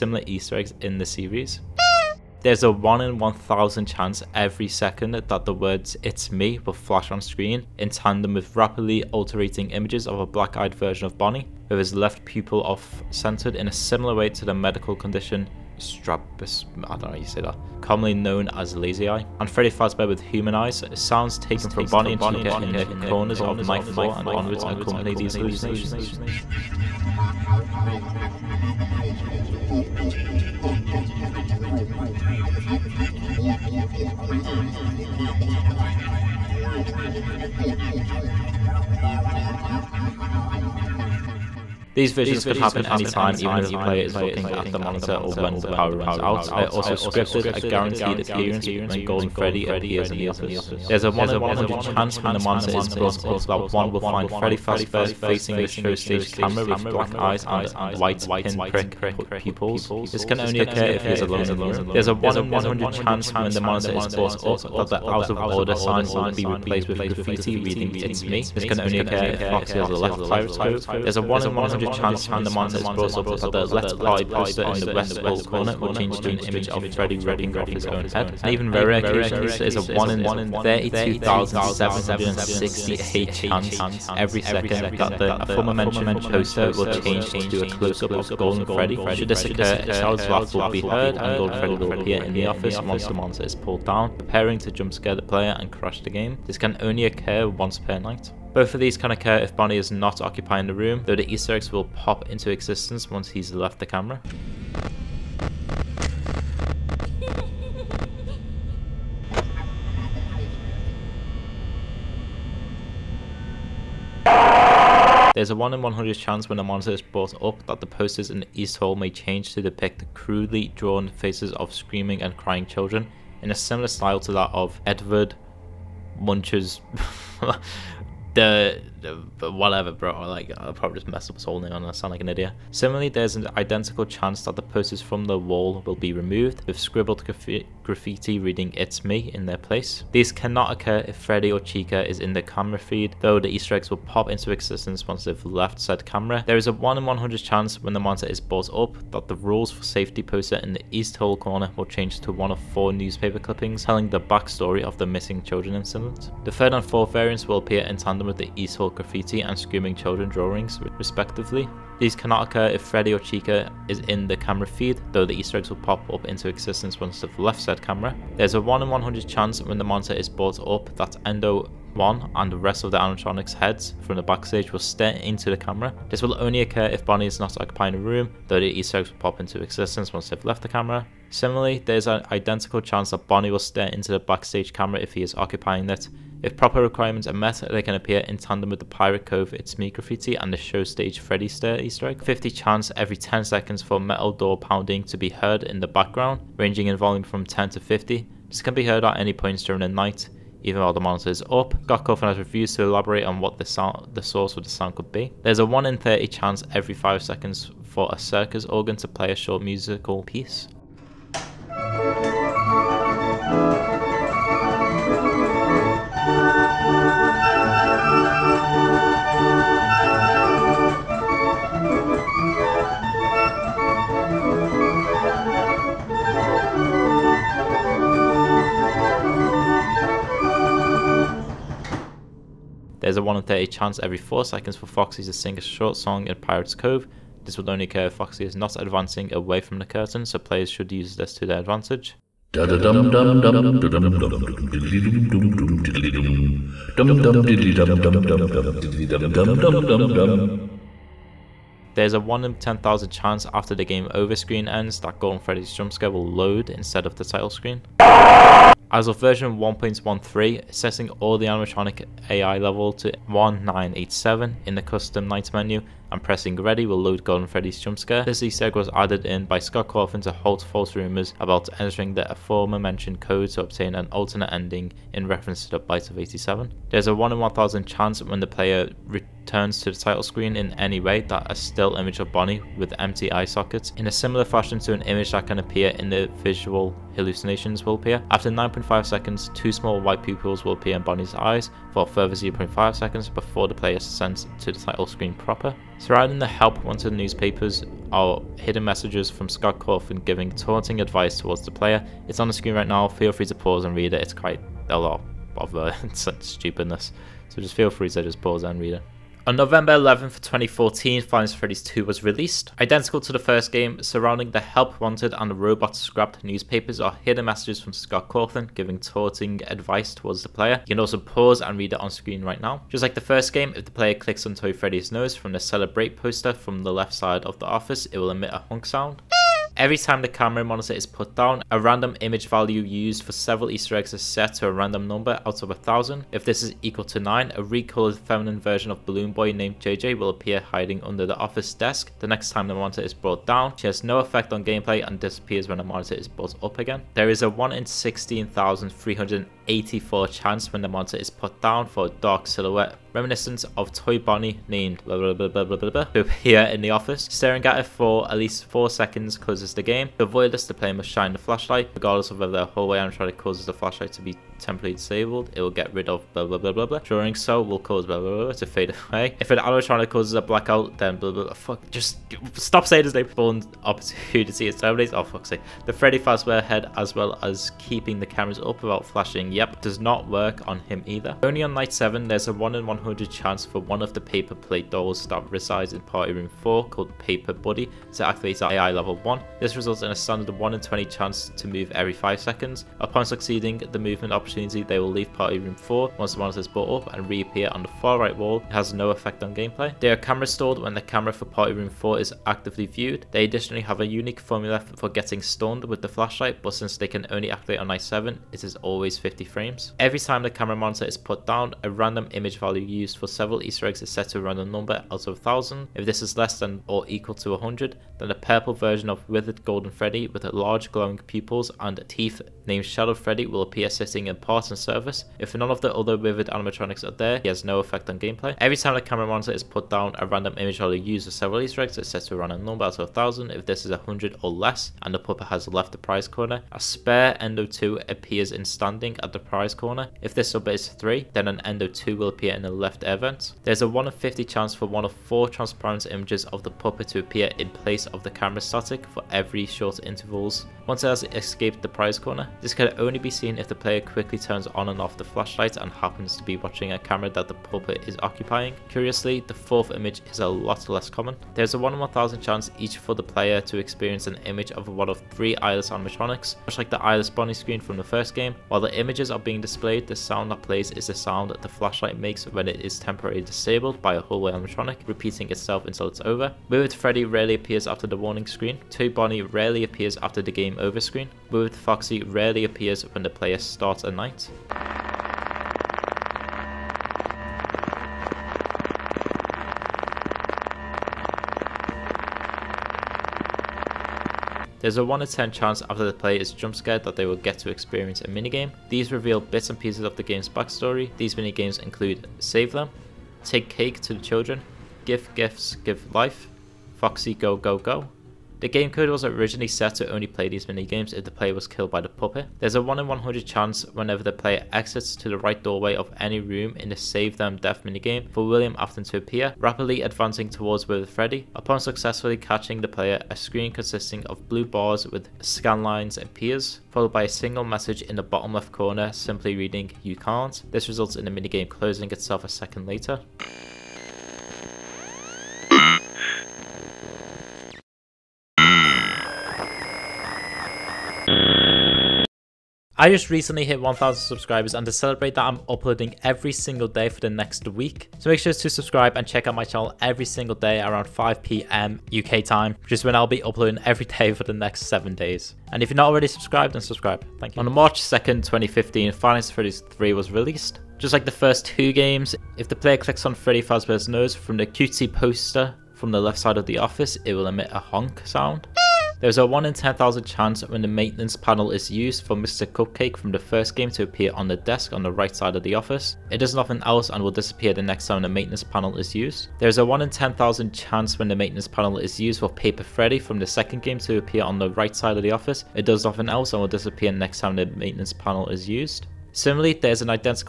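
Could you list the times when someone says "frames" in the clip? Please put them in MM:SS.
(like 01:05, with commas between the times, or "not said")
06:49.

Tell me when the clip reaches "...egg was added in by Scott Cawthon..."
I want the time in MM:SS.
04:28.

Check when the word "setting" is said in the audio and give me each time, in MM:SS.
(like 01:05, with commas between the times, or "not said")
04:20.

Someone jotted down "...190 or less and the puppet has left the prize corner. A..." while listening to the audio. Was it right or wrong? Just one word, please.
wrong.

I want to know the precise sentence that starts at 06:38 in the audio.
It has no effect on gameplay.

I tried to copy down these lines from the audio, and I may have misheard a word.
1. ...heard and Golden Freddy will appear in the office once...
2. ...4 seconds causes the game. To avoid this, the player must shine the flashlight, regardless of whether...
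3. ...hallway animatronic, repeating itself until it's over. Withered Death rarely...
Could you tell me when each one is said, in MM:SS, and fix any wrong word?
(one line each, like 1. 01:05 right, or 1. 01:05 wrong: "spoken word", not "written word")
1. 01:30 right
2. 05:58 right
3. 07:54 wrong: "Freddy", not "Death".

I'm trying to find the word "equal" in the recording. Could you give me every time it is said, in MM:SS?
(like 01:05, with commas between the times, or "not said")
05:36, 06:57.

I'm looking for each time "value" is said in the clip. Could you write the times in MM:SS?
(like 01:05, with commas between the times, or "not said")
05:32, 06:52.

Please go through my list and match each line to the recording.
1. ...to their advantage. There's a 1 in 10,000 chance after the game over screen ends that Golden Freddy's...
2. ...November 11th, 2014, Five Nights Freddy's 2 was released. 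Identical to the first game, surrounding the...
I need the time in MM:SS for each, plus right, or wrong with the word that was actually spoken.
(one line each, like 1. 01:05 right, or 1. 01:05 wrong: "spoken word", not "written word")
1. 04:01 right
2. 05:09 right.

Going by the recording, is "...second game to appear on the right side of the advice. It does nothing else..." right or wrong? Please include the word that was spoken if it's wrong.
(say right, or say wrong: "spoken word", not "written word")
wrong: "office", not "advice".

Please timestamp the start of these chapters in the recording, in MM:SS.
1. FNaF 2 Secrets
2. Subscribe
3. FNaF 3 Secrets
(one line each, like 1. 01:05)
1. 05:08
2. 09:02
3. 09:16.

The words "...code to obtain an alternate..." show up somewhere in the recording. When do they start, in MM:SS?
04:33.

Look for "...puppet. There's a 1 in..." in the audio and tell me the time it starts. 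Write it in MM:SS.
08:32.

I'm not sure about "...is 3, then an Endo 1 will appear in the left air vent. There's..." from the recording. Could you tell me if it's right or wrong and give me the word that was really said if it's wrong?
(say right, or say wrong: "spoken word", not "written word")
wrong: "2", not "1".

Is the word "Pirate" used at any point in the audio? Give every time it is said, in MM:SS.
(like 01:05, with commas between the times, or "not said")
01:10, 03:08, 03:56.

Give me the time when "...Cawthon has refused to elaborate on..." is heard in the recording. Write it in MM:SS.
03:22.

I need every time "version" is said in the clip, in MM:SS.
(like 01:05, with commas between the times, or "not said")
00:10, 04:19, 05:38, 06:58.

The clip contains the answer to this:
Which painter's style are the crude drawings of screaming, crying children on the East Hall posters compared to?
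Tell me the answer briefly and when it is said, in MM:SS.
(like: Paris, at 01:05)
Edward Munch, at 02:04.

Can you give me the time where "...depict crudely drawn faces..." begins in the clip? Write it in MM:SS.
01:59.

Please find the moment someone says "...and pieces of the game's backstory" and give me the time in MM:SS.
08:19.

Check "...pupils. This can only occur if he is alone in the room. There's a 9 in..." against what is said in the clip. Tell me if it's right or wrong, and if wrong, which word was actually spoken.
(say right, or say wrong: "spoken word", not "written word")
wrong: "1", not "9".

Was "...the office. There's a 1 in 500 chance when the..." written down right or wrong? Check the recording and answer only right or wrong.
wrong.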